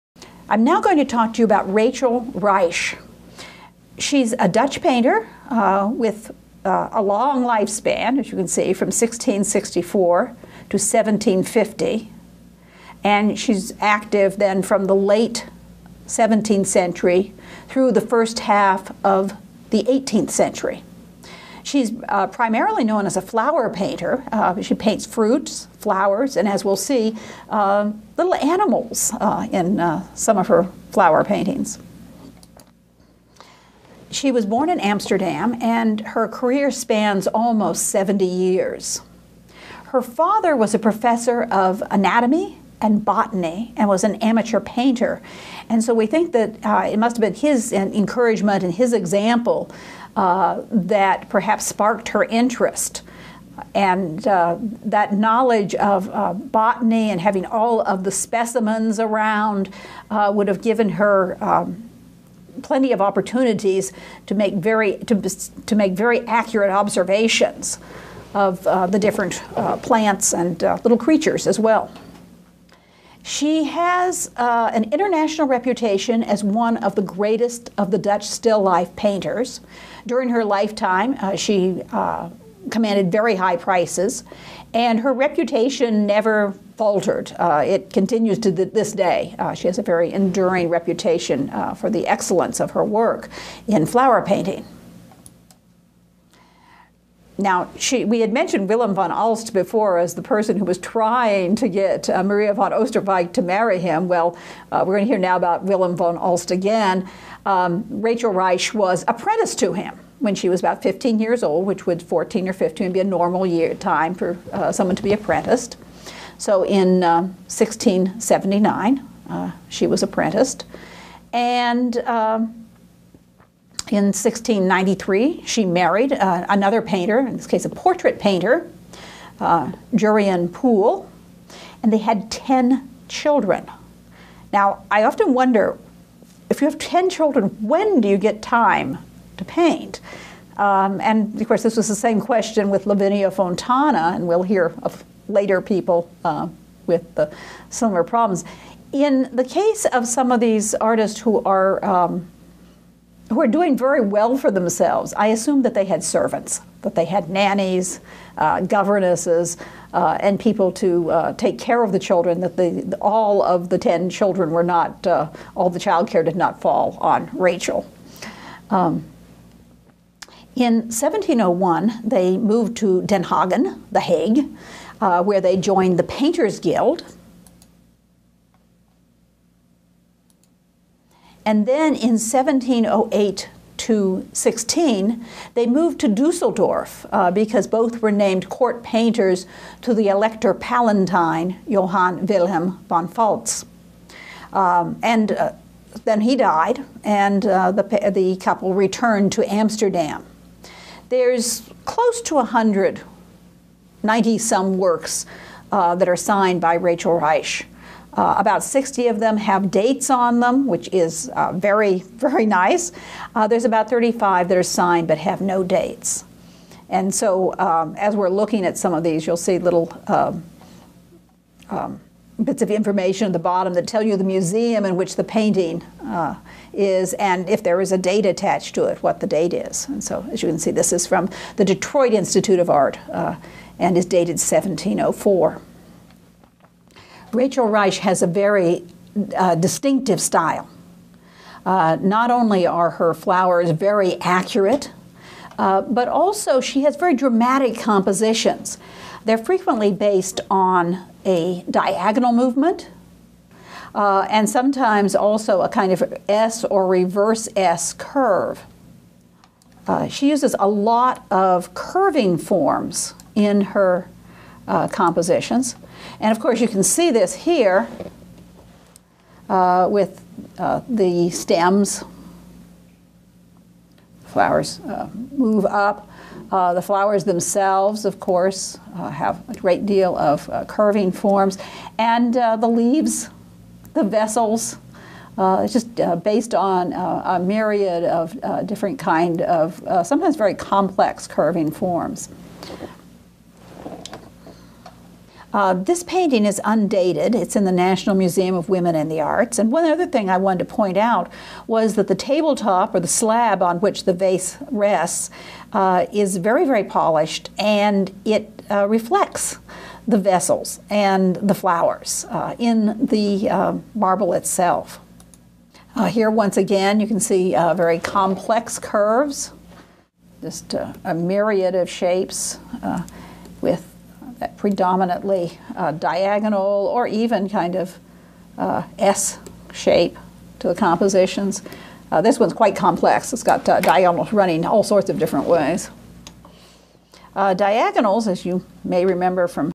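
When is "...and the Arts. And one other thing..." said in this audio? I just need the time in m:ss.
4:58.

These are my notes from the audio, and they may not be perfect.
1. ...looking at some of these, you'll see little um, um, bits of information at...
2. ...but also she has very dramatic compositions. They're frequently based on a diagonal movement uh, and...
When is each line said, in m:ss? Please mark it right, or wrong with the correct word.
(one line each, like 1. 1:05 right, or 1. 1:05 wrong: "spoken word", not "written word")
1. 3:38 right
2. 4:05 right.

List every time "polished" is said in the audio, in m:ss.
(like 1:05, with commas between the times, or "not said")
5:06.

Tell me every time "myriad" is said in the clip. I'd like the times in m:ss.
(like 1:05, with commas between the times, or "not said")
4:47, 5:21.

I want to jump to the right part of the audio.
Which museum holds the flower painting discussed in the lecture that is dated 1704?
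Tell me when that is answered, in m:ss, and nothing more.
3:51.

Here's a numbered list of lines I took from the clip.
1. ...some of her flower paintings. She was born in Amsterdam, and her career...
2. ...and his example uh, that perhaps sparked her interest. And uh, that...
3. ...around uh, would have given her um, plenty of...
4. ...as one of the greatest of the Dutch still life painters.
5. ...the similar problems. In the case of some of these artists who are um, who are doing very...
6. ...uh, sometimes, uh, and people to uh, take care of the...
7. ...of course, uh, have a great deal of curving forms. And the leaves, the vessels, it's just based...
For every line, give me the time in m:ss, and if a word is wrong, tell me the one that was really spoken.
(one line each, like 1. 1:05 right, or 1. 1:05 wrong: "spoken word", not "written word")
1. 0:30 right
2. 0:48 right
3. 0:58 right
4. 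1:16 right
5. 2:27 right
6. 2:38 wrong: "governesses", not "sometimes"
7. 4:38 right.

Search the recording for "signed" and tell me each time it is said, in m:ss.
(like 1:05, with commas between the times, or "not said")
3:26, 3:34.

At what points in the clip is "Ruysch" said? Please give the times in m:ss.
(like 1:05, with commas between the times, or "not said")
0:02, 1:48, 3:27, 3:57.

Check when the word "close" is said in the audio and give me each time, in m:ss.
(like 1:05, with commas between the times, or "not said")
3:21.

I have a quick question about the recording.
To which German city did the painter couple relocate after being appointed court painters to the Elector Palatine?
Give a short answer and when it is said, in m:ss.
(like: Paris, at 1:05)
Dusseldorf, at 3:06.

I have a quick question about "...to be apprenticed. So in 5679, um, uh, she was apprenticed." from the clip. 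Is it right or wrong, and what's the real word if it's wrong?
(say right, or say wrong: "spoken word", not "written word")
wrong: "1679", not "5679".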